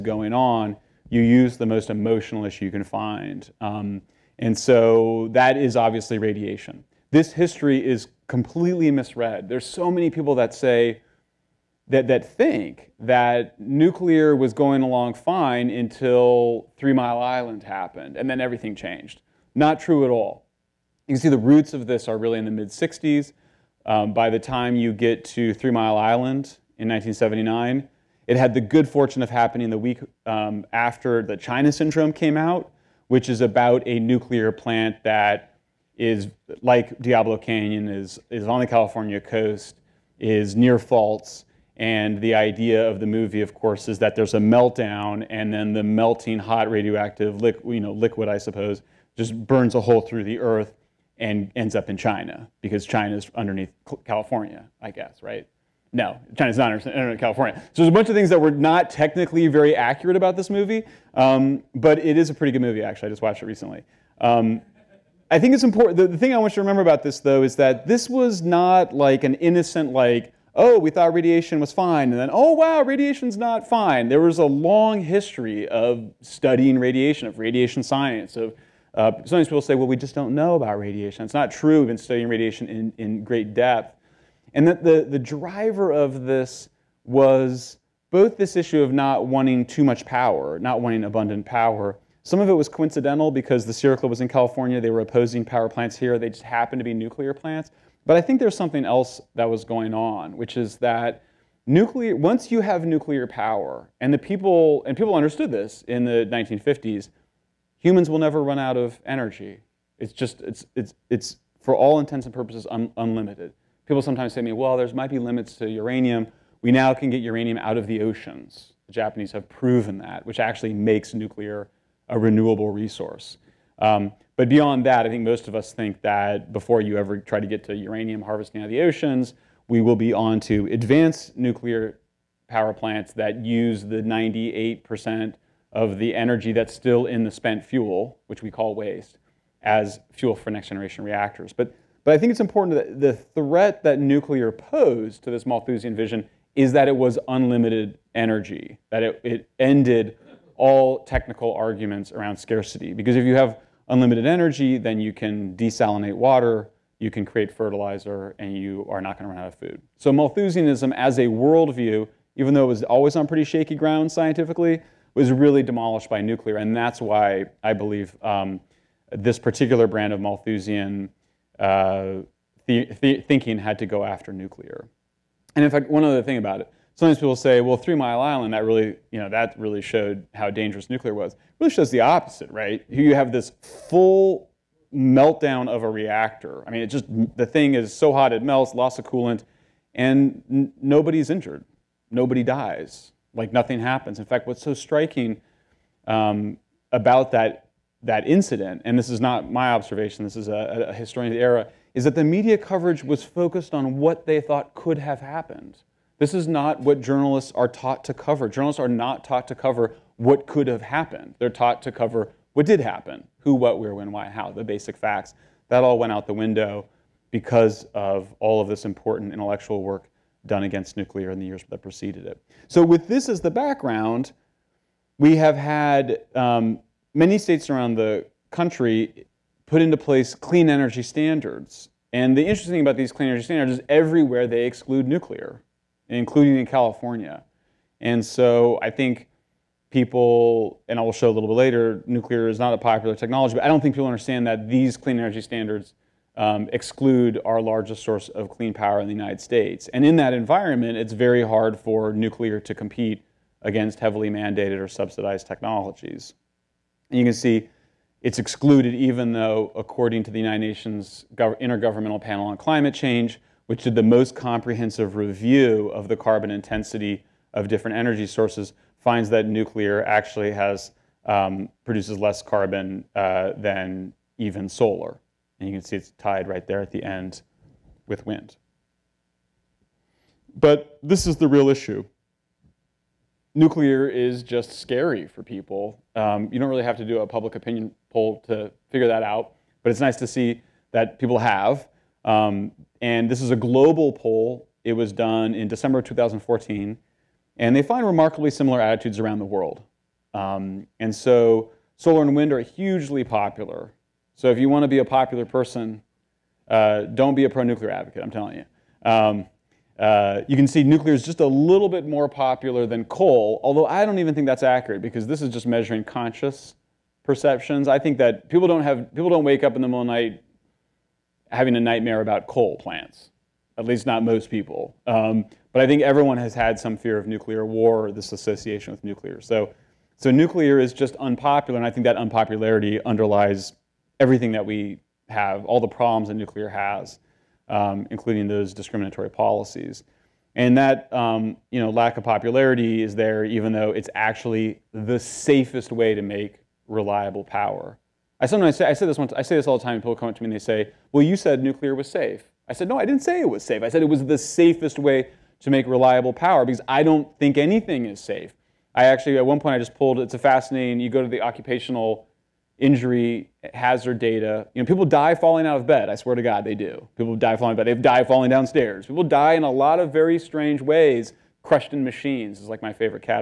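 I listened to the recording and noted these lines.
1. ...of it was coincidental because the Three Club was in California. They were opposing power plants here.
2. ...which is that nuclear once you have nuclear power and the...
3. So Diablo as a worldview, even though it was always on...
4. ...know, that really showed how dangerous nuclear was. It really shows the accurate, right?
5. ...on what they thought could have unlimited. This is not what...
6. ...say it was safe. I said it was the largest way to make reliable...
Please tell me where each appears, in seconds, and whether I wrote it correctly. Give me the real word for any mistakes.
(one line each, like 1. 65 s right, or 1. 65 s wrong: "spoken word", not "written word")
1. 92 s wrong: "Sierra", not "Three"
2. 100 s right
3. 159 s wrong: "Malthusianism", not "Diablo"
4. 179 s wrong: "opposite", not "accurate"
5. 203 s wrong: "happened", not "unlimited"
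6. 353 s wrong: "safest", not "largest".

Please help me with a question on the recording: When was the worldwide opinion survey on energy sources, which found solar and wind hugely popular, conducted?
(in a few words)
December 2014.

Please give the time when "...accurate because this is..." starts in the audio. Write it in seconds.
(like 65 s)
314 s.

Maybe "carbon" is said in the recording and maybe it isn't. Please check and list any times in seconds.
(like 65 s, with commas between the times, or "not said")
266 s, 272 s.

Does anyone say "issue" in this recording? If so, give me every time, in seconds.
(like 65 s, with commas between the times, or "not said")
2 s, 88 s, 281 s.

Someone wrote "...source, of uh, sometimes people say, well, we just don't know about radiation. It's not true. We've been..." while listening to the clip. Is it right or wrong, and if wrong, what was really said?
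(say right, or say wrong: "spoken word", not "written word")
wrong: "science", not "source".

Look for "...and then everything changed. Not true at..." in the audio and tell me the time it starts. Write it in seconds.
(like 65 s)
18 s.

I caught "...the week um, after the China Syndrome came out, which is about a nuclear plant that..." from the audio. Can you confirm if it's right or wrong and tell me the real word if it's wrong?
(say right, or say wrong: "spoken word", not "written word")
right.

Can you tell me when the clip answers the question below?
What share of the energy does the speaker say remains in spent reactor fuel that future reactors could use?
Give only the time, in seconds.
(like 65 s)
134 s.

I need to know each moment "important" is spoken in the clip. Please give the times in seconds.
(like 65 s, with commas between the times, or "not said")
65 s, 142 s, 218 s.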